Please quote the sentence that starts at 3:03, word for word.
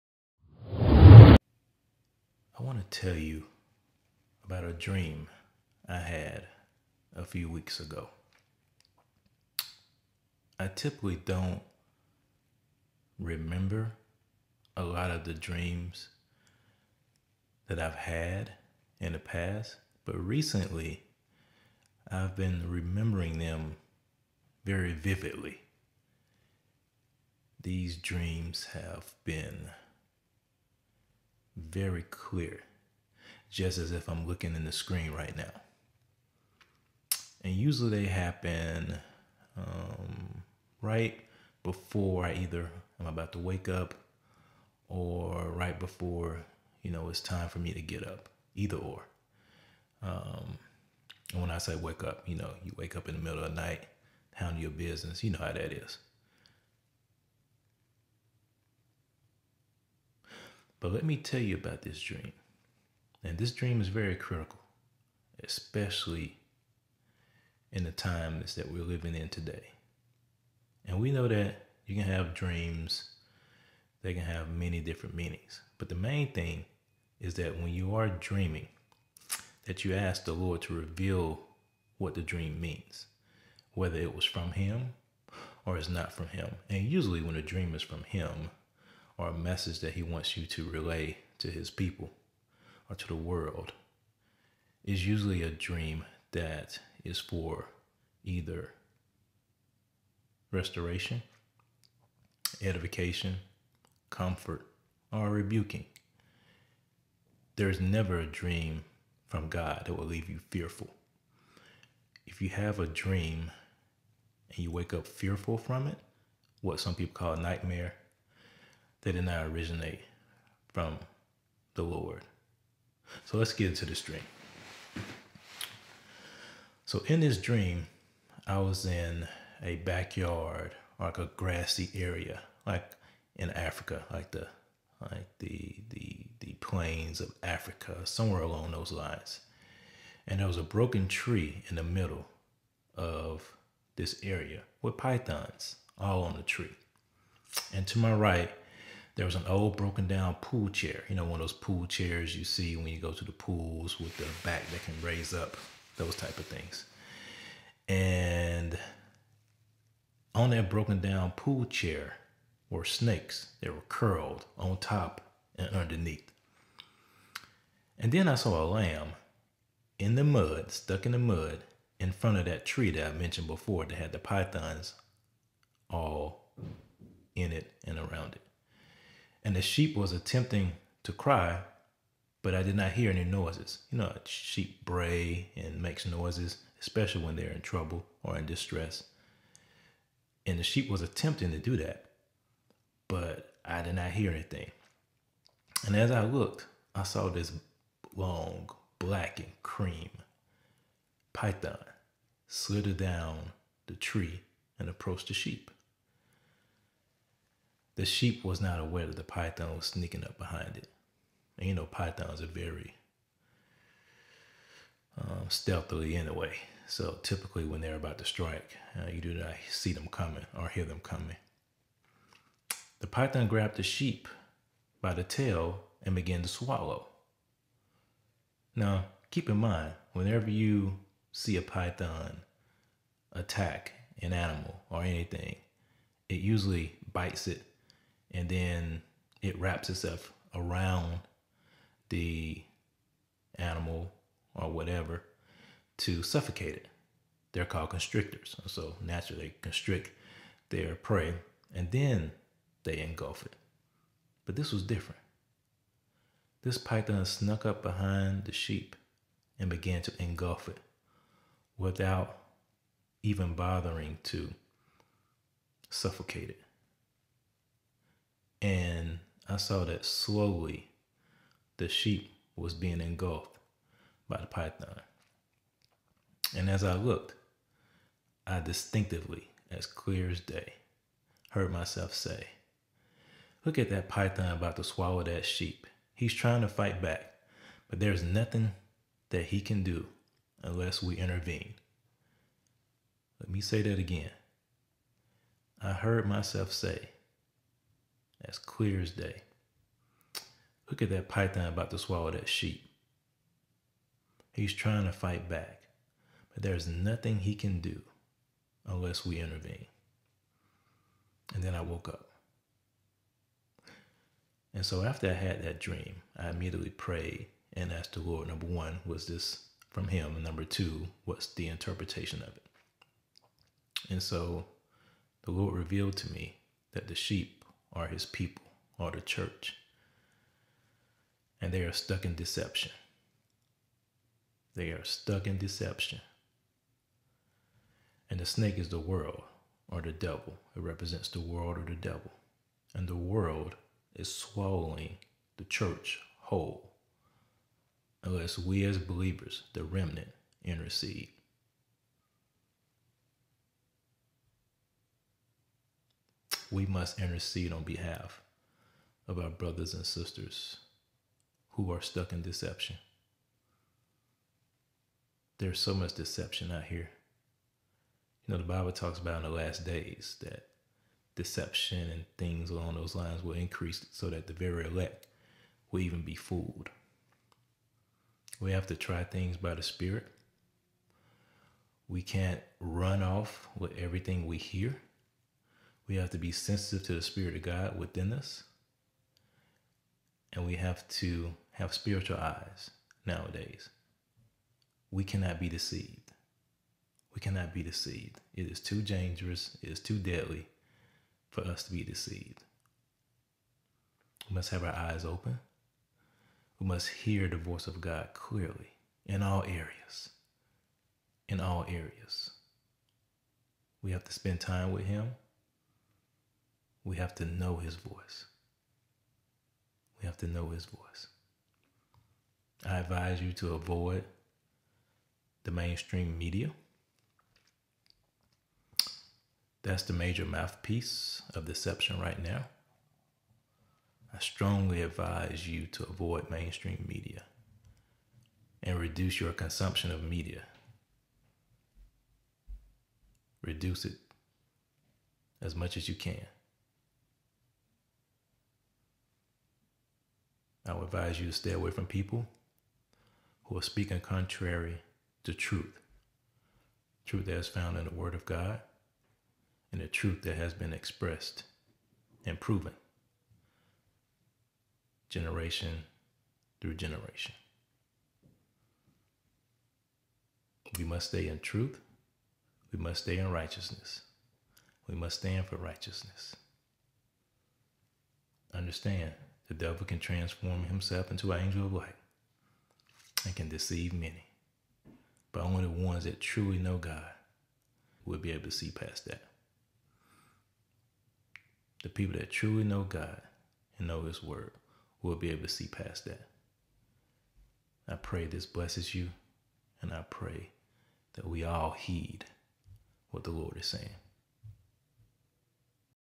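You know, sheep bray and makes noises, especially when they're in trouble or in distress.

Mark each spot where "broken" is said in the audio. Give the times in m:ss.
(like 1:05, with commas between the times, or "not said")
2:20, 2:29, 2:40.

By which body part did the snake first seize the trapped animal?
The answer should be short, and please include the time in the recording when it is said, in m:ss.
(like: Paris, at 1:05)
the tail, at 3:45.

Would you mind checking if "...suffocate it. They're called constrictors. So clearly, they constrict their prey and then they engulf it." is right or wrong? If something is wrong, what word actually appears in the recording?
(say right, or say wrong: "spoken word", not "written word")
wrong: "naturally", not "clearly".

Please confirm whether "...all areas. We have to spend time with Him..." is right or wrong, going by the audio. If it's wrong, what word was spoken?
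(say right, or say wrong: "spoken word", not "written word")
right.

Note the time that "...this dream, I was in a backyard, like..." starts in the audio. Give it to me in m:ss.
2:07.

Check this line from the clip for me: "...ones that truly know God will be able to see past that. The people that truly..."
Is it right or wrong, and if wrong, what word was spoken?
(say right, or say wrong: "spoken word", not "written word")
right.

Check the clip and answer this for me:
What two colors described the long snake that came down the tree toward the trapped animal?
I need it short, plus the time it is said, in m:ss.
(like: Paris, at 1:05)
black and cream, at 3:18.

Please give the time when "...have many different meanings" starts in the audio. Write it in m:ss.
1:14.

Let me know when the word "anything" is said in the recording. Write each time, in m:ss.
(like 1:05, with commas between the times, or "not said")
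3:14, 3:55.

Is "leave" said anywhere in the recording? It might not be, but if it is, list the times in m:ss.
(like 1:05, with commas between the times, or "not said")
1:50.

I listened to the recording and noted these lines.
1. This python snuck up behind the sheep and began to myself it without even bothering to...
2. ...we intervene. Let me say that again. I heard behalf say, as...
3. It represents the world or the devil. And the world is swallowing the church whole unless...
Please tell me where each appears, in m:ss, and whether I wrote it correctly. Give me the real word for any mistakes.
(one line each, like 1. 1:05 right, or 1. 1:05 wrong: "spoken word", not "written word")
1. 4:16 wrong: "engulf", not "myself"
2. 4:51 wrong: "myself", not "behalf"
3. 5:40 right.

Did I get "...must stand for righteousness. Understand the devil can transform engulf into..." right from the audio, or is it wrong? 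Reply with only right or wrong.
wrong.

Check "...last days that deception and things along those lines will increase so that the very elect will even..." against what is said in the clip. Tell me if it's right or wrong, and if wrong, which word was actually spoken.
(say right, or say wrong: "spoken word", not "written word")
right.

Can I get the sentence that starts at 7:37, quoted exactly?
Truth that is found in the Word of God and the truth that has been expressed and proven generation through generation.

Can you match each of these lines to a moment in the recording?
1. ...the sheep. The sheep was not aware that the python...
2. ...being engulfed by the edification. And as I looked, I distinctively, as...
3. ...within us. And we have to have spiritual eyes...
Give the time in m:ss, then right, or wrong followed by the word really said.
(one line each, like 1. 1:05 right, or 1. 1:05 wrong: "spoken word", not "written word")
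1. 3:25 right
2. 4:32 wrong: "python", not "edification"
3. 6:27 right.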